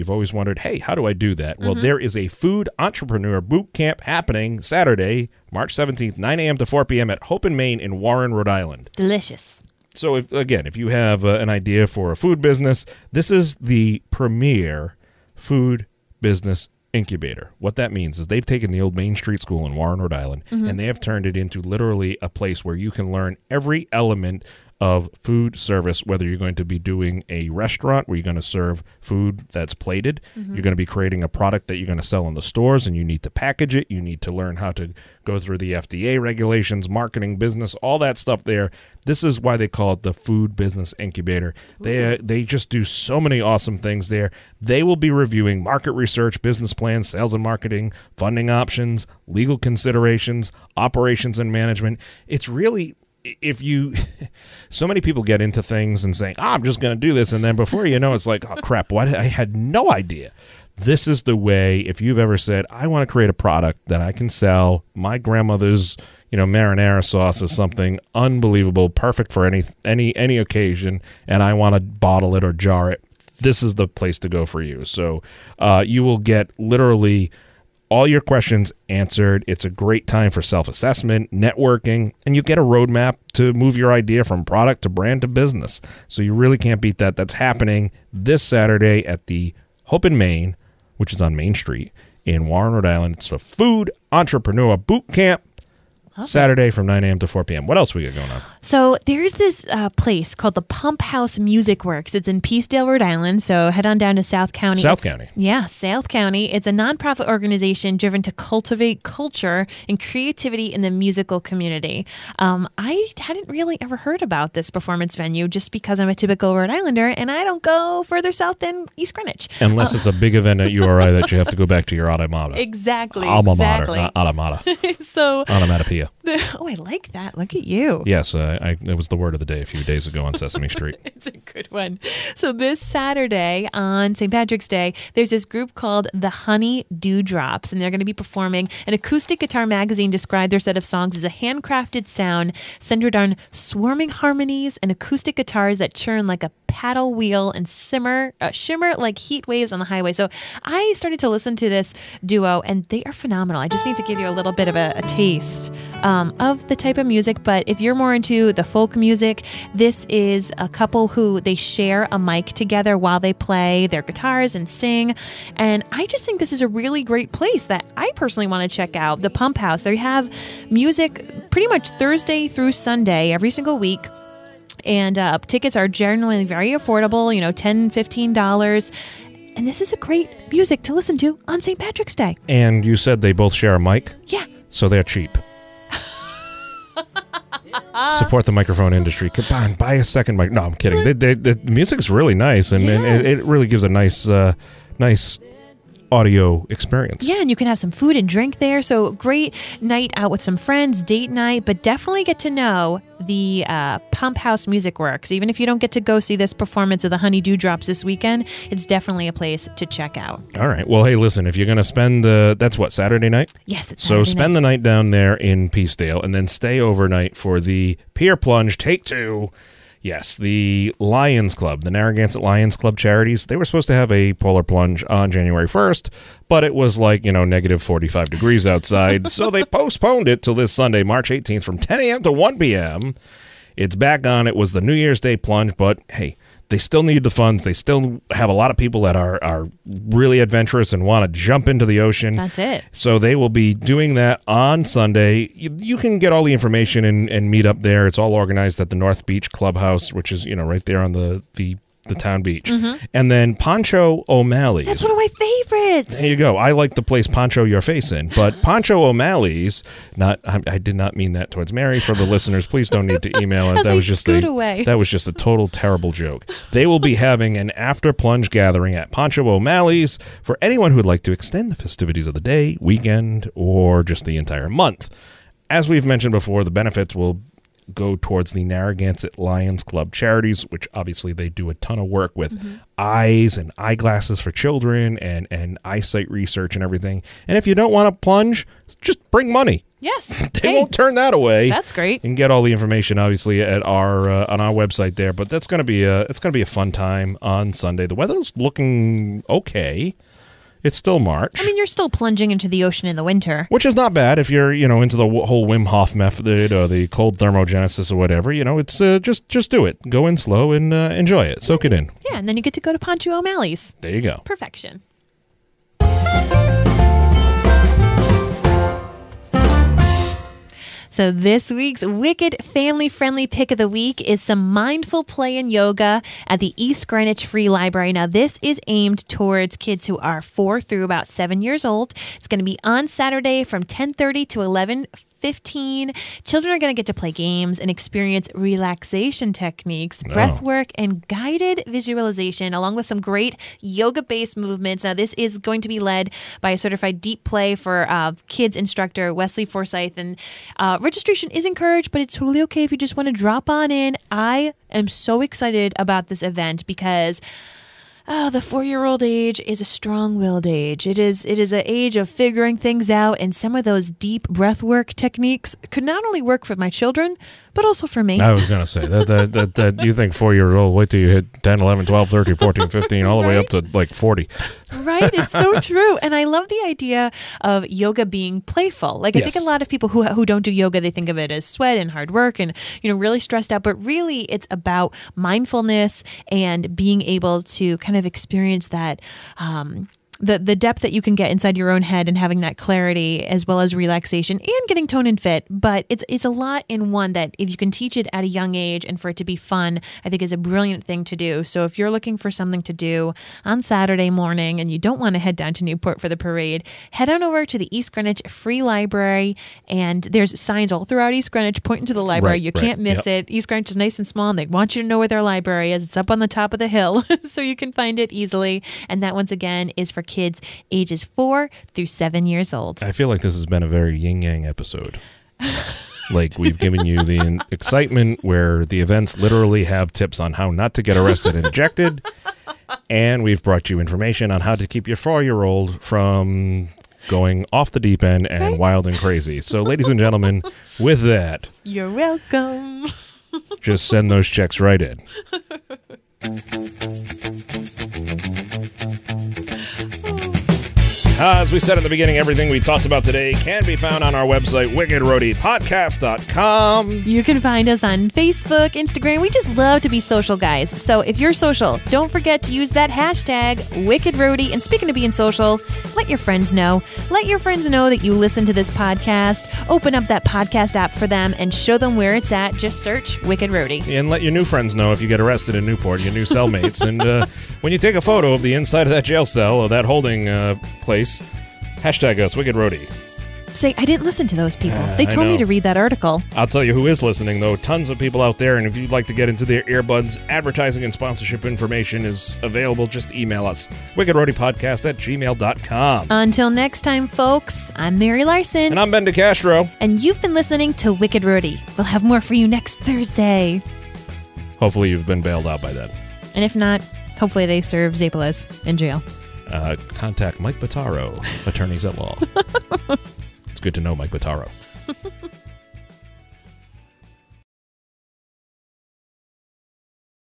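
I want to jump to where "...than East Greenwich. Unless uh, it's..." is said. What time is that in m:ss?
1:58.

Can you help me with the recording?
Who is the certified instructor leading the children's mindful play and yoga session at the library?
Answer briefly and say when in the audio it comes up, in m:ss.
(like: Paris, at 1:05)
Wesley Forsyth, at 5:49.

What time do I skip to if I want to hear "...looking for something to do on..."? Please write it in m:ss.
6:42.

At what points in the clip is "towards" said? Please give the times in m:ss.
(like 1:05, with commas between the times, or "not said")
4:21, 4:38, 5:29.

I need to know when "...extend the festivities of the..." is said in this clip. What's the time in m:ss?
4:31.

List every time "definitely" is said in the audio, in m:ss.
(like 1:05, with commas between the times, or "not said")
3:21, 3:28.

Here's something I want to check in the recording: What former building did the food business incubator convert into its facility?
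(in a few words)
Main Street School.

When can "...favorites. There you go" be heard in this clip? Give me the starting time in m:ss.
4:15.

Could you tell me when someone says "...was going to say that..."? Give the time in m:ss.
6:08.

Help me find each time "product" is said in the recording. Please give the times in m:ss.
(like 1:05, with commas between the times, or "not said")
0:31, 1:03, 1:24.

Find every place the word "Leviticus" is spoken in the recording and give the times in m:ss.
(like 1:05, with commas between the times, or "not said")
not said.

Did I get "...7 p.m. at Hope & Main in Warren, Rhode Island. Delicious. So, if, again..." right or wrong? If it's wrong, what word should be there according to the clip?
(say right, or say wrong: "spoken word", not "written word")
wrong: "4", not "7".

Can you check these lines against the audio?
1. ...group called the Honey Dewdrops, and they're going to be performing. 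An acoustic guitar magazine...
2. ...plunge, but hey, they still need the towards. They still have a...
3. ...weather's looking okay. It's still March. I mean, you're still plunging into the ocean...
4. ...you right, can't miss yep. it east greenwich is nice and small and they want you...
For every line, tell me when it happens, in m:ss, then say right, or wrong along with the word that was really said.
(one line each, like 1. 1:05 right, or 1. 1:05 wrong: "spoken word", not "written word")
1. 2:15 right
2. 3:55 wrong: "funds", not "towards"
3. 4:58 right
4. 6:52 right.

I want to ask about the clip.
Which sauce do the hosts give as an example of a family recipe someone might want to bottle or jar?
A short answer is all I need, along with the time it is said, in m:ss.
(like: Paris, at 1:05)
Marinara sauce, at 1:06.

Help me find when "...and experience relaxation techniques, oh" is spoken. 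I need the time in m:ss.
5:37.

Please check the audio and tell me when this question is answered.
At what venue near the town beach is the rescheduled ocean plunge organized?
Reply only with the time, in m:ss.
4:08.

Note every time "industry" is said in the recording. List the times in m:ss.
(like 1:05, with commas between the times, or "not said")
3:08.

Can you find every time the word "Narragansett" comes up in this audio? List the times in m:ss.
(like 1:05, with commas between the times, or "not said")
3:41, 4:38.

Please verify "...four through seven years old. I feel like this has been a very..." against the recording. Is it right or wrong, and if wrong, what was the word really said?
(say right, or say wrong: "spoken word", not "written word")
right.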